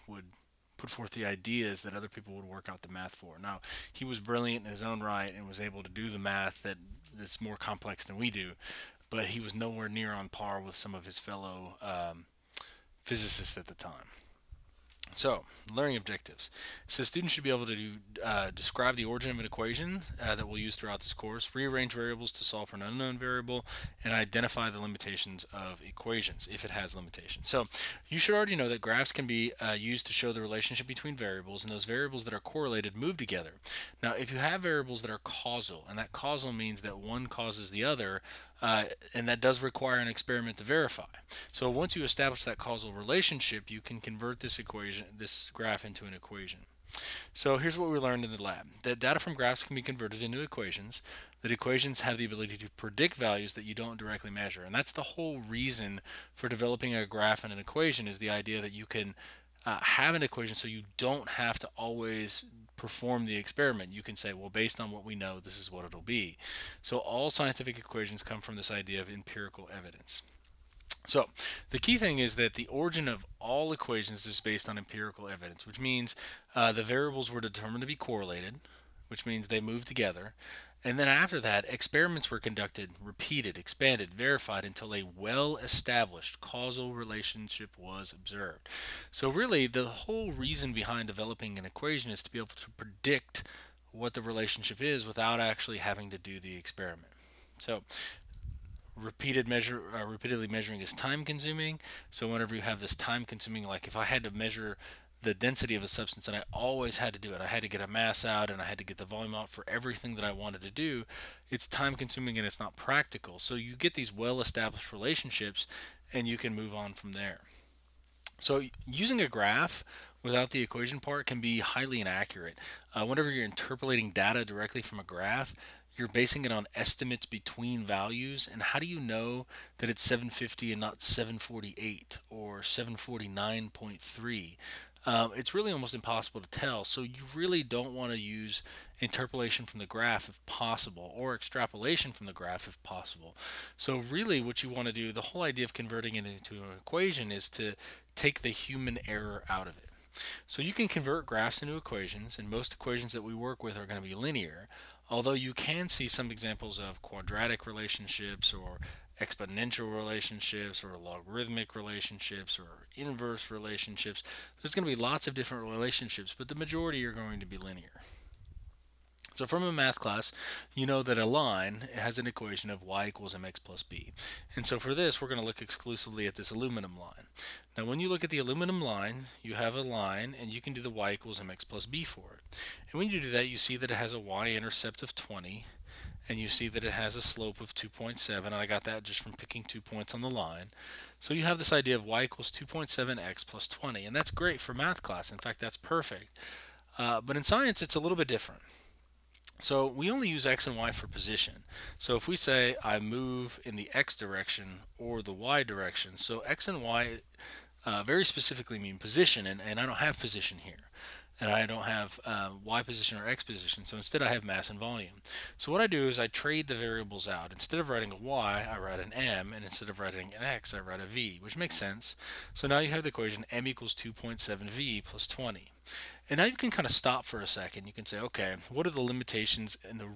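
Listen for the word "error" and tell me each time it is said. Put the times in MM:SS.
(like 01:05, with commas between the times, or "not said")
02:29.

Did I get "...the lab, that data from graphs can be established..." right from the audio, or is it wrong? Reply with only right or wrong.
wrong.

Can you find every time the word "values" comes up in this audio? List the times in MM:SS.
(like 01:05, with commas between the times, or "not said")
00:53, 02:07.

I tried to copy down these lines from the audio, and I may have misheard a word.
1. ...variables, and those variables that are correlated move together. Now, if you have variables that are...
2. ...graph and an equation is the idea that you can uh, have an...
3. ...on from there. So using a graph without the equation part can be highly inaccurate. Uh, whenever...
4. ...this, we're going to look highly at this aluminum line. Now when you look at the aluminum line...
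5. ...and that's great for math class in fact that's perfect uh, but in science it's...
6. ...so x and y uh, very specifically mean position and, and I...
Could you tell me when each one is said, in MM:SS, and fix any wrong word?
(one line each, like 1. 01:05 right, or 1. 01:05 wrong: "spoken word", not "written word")
1. 00:31 right
2. 00:57 right
3. 01:56 right
4. 02:54 wrong: "exclusively", not "highly"
5. 03:14 right
6. 03:26 right.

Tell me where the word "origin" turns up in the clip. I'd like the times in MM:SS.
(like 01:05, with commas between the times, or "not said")
00:19, 01:12.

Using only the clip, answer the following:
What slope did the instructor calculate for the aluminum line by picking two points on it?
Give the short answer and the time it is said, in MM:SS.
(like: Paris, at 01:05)
2.7, at 03:07.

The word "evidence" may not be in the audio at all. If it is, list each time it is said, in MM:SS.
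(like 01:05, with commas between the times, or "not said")
01:09, 01:15.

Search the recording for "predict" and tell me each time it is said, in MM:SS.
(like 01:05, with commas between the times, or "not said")
00:52, 01:32.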